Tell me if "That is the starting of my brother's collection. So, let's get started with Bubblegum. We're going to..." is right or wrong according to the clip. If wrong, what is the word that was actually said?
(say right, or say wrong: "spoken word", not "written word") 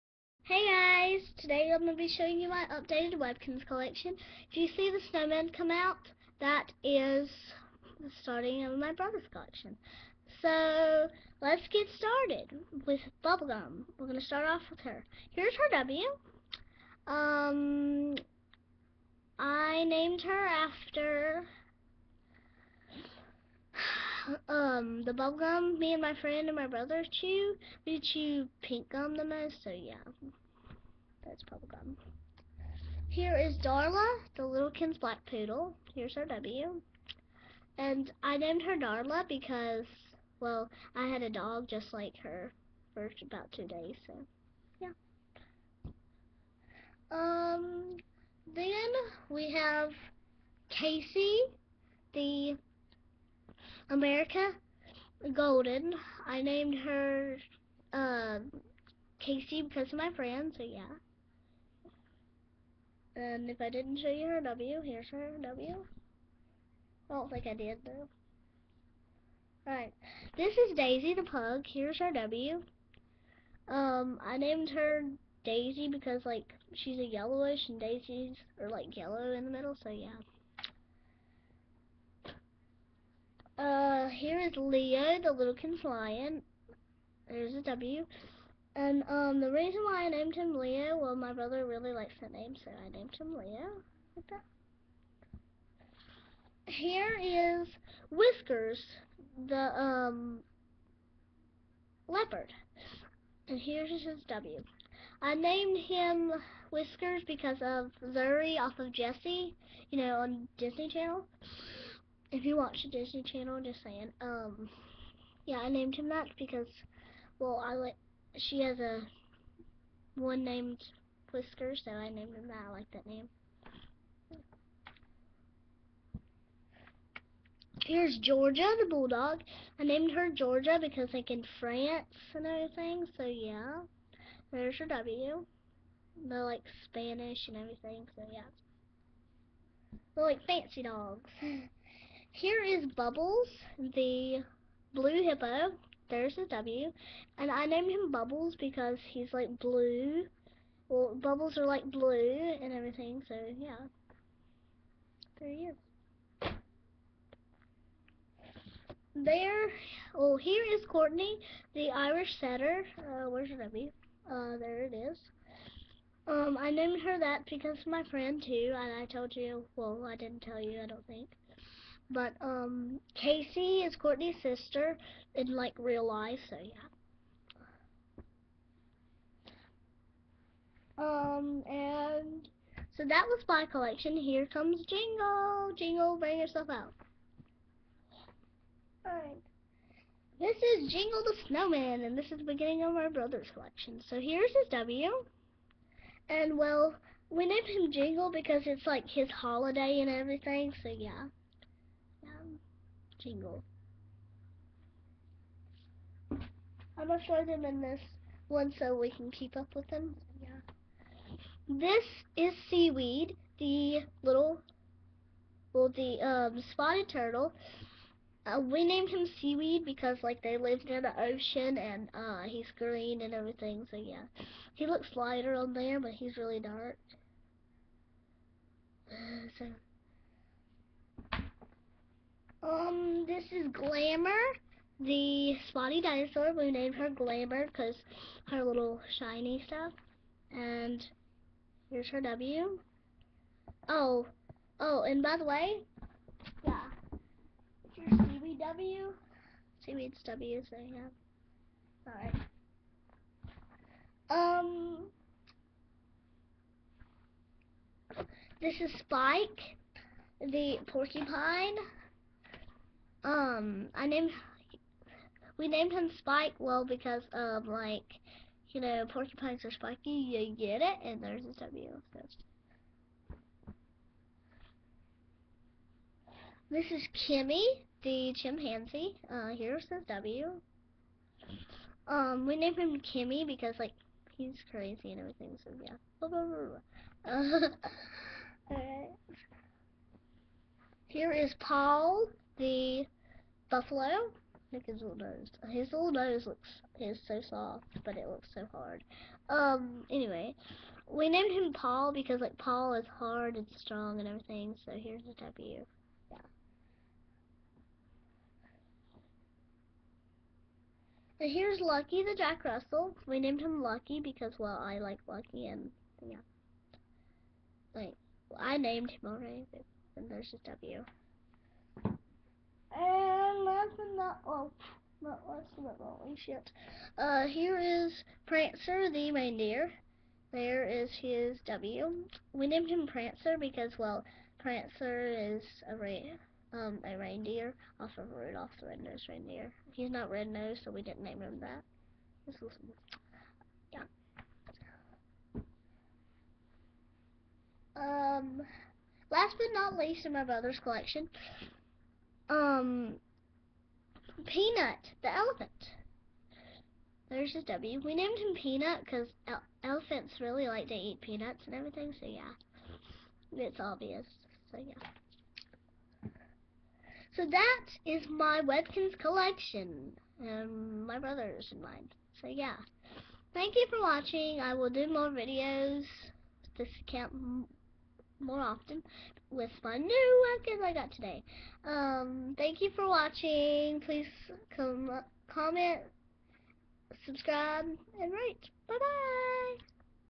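right.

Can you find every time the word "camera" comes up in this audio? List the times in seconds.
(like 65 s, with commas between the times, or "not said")
not said.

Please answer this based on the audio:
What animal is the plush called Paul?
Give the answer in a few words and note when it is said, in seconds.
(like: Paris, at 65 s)
Buffalo, at 293 s.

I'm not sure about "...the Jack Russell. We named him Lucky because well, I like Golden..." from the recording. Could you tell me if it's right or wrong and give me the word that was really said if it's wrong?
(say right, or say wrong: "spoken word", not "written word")
wrong: "Lucky", not "Golden".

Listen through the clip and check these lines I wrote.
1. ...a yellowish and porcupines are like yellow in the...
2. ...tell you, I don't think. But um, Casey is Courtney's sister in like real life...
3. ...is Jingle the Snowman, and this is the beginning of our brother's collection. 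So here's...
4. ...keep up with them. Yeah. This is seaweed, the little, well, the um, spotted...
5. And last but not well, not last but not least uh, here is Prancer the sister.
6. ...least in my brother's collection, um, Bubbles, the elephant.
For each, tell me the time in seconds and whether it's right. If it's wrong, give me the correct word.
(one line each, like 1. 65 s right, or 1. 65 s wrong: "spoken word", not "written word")
1. 76 s wrong: "daisies", not "porcupines"
2. 170 s right
3. 190 s right
4. 209 s right
5. 322 s wrong: "reindeer", not "sister"
6. 349 s wrong: "Peanut", not "Bubbles".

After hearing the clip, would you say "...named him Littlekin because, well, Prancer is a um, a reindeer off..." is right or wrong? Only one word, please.
wrong.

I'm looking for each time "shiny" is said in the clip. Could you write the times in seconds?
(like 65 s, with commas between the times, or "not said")
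239 s.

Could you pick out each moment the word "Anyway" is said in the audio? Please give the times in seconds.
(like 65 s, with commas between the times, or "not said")
300 s.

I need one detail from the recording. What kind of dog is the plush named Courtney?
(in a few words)
Irish setter.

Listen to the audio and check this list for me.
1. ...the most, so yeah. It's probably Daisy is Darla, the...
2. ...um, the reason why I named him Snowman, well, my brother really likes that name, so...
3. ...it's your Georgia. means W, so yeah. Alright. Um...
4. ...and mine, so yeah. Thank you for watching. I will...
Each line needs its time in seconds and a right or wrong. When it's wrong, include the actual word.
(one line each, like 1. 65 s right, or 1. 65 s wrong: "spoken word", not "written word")
1. 29 s wrong: "Here", not "Daisy"
2. 89 s wrong: "Leo", not "Snowman"
3. 247 s wrong: "CBW", not "Georgia"
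4. 371 s right.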